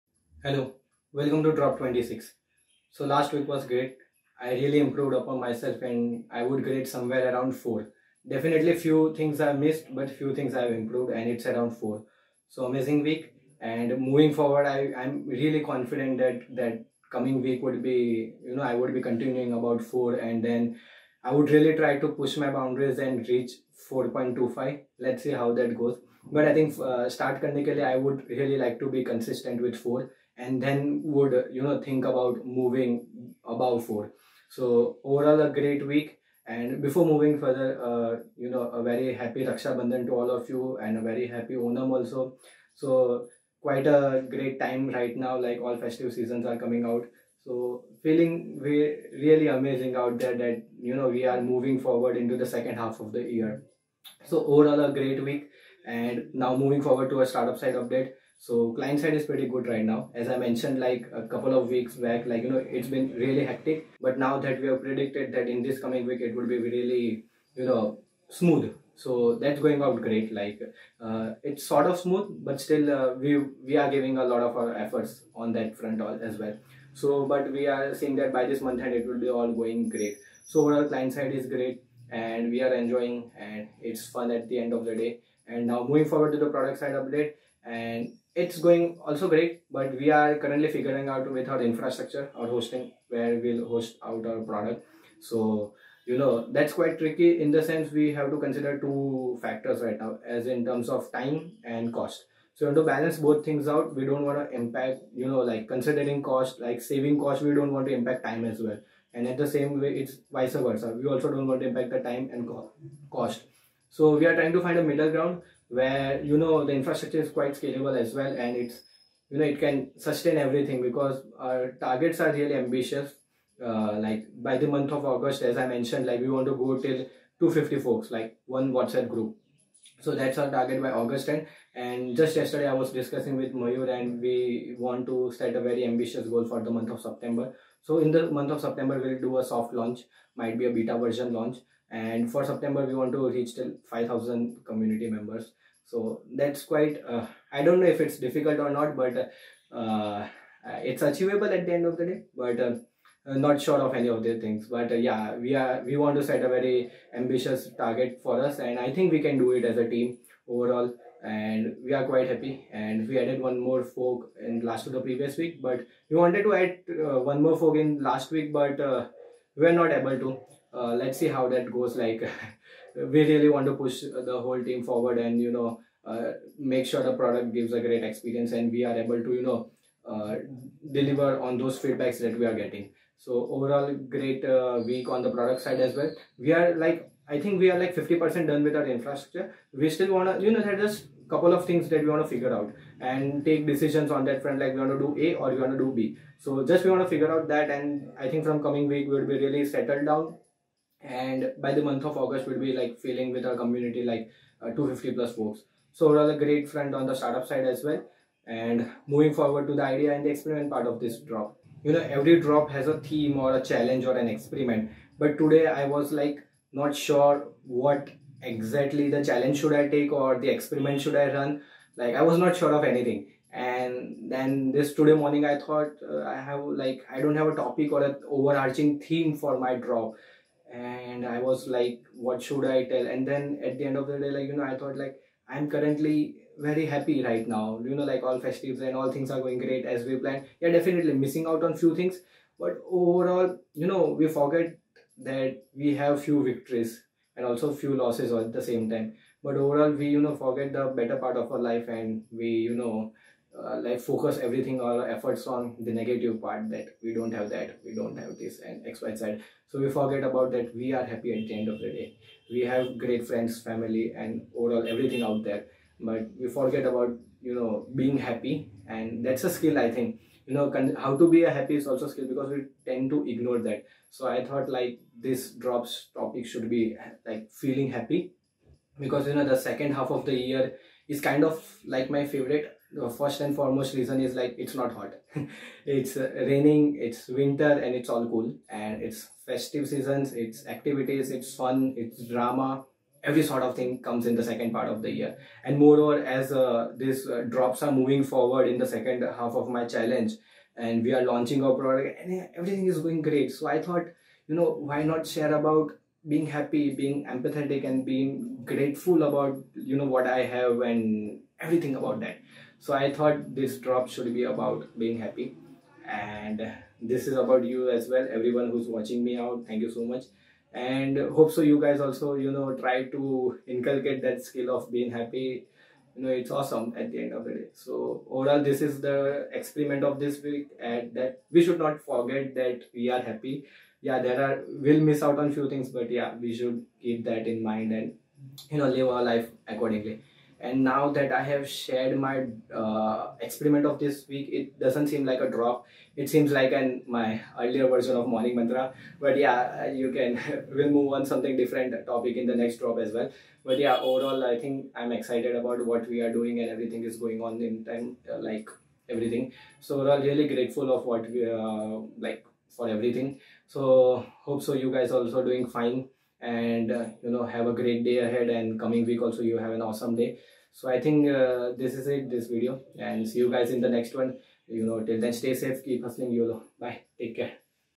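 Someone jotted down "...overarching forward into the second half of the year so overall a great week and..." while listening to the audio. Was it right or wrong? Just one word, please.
wrong.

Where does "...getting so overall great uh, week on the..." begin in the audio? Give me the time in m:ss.
3:02.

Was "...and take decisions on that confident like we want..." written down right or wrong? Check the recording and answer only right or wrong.
wrong.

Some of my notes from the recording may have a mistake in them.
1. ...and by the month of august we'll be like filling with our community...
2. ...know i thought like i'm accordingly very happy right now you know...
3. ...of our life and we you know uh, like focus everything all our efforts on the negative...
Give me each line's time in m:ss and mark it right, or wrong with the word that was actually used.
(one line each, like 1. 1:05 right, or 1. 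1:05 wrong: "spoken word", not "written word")
1. 3:21 right
2. 3:54 wrong: "currently", not "accordingly"
3. 4:11 right.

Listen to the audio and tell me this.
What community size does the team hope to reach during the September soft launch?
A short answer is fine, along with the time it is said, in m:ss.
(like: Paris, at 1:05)
5000, at 2:23.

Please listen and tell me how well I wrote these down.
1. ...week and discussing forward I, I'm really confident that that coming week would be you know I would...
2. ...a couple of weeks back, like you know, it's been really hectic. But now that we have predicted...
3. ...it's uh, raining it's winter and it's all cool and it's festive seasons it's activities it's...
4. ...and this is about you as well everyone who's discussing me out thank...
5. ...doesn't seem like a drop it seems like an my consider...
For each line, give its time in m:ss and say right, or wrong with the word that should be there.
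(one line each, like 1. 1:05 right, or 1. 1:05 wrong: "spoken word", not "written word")
1. 0:13 wrong: "moving", not "discussing"
2. 1:01 right
3. 4:45 right
4. 5:16 wrong: "watching", not "discussing"
5. 5:44 wrong: "earlier", not "consider".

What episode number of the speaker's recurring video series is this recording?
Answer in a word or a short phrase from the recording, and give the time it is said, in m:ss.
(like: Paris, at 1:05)
26, at 0:01.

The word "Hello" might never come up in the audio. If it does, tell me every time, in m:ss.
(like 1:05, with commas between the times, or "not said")
0:00.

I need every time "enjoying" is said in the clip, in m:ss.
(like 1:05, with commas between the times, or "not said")
1:22.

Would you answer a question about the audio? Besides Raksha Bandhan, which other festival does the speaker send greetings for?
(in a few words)
Onam.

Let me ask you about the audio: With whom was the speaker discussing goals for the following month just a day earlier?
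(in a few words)
Mayur.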